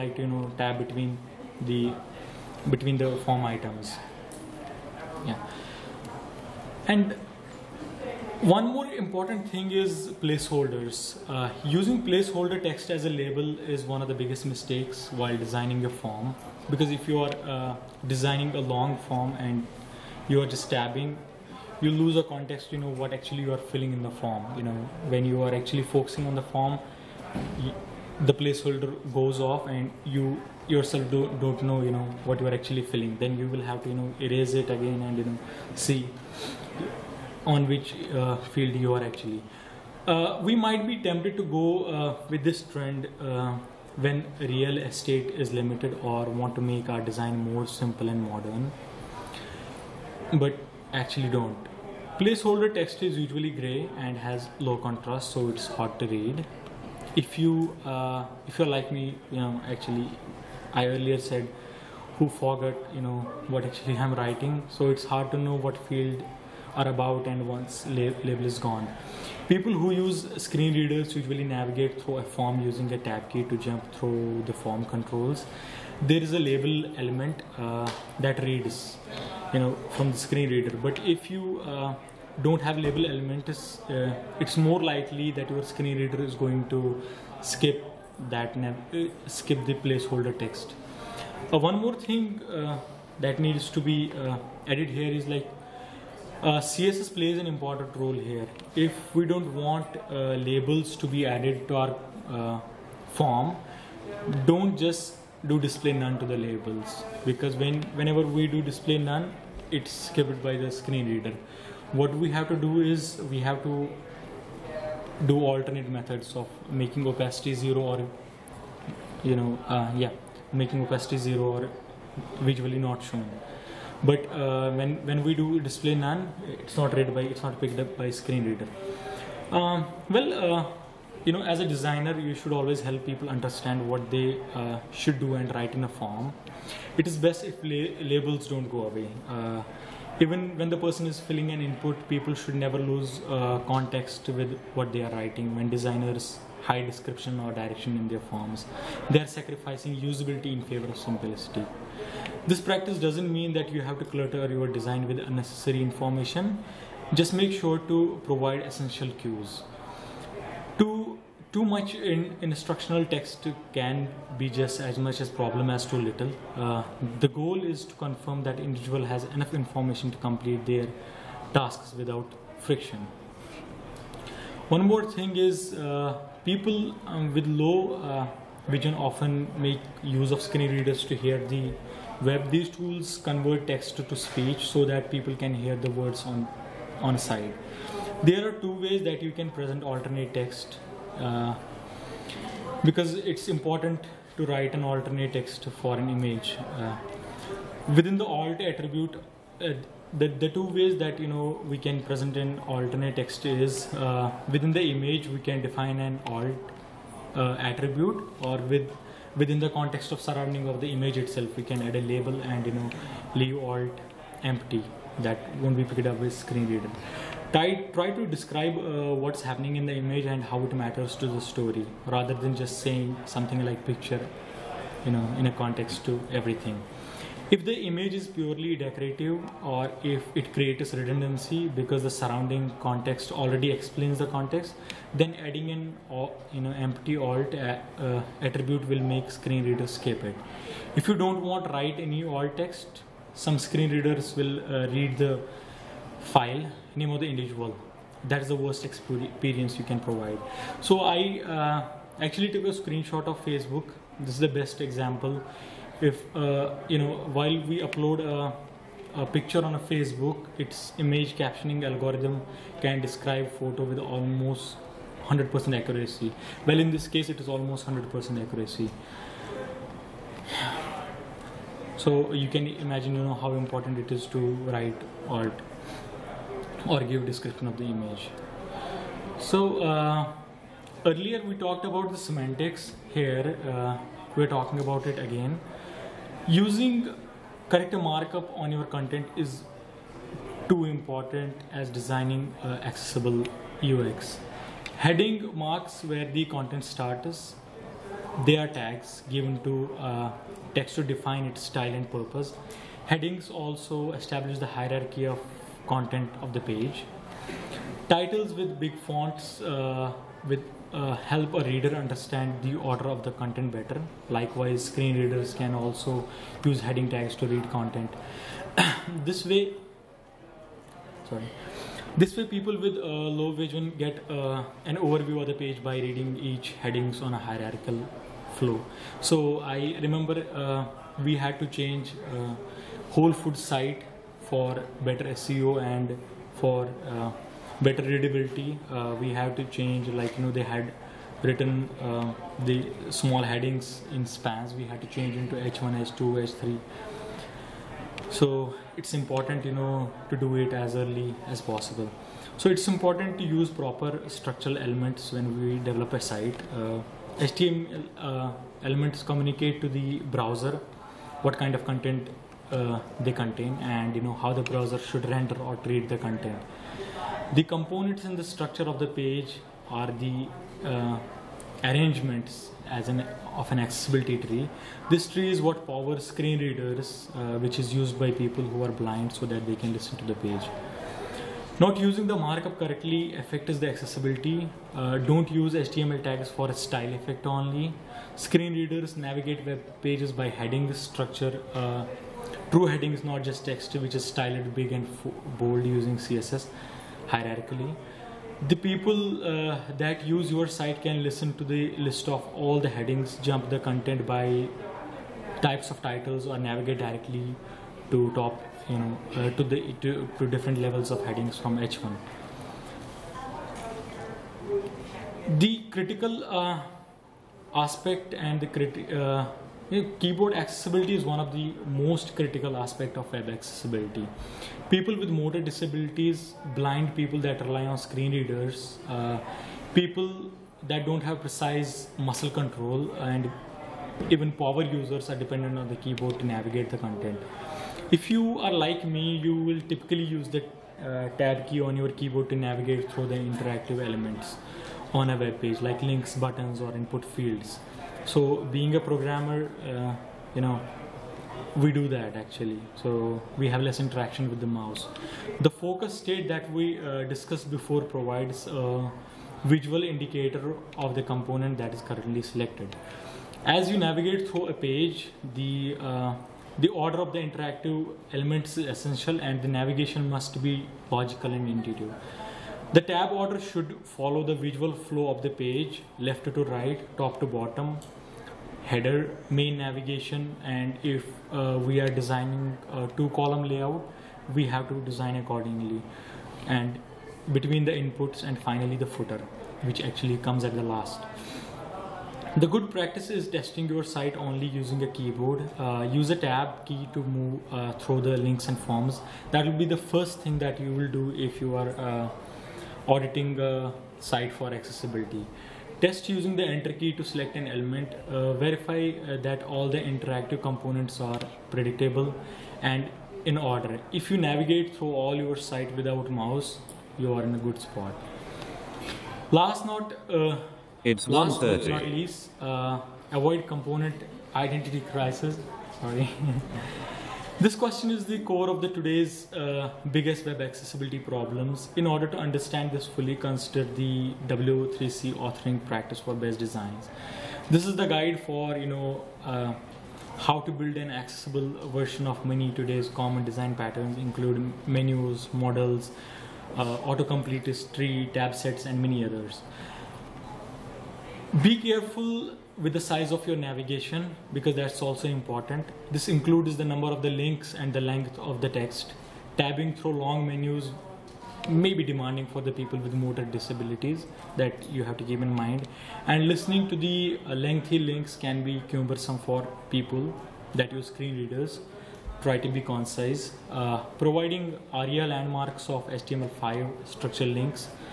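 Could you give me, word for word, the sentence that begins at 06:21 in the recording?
Not using the markup correctly affects the accessibility.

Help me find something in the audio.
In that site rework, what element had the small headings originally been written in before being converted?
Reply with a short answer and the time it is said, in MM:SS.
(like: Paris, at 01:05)
spans, at 05:44.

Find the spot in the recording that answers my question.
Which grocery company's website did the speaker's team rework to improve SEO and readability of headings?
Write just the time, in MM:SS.
05:33.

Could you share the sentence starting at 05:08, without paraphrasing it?
Titles with big fonts uh, with uh, help a reader understand the order of the content better.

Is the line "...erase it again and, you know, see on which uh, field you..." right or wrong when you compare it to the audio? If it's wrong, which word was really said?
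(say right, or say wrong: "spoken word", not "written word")
right.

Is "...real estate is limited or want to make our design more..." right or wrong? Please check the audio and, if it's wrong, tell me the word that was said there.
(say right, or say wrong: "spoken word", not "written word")
right.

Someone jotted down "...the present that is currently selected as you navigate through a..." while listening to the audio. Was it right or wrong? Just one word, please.
wrong.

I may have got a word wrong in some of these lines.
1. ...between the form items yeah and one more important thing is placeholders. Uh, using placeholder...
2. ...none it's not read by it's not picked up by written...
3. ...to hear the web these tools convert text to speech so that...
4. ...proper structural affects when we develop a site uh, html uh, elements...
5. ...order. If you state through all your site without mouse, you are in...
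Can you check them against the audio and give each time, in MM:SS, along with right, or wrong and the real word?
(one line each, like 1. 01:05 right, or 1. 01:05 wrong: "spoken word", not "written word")
1. 00:02 right
2. 02:05 wrong: "screen", not "written"
3. 03:01 right
4. 05:53 wrong: "elements", not "affects"
5. 08:33 wrong: "navigate", not "state".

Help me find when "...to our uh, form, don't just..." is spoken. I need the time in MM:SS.
01:41.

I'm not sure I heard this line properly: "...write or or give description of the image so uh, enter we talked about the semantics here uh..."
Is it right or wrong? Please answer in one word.
wrong.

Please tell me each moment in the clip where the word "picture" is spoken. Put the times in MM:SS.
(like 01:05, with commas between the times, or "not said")
03:43, 04:19.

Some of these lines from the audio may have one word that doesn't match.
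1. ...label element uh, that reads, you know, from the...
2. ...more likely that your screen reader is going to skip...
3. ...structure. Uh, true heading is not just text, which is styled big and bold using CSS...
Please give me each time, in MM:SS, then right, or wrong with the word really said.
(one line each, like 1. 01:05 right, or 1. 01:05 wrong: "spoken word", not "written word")
1. 01:16 right
2. 01:24 right
3. 06:30 right.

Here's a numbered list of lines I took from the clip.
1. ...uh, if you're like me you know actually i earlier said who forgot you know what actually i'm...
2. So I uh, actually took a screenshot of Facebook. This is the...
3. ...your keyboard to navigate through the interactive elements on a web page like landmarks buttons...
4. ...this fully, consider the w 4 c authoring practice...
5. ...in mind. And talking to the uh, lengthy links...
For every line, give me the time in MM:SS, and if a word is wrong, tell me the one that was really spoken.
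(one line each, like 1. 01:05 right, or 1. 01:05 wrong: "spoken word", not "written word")
1. 00:57 right
2. 04:10 right
3. 07:21 wrong: "links", not "landmarks"
4. 08:52 wrong: "3", not "4"
5. 09:25 wrong: "listening", not "talking".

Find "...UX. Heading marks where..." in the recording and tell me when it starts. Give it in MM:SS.
04:53.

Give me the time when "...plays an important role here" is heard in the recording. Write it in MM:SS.
01:37.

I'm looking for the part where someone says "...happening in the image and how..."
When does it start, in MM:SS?
03:39.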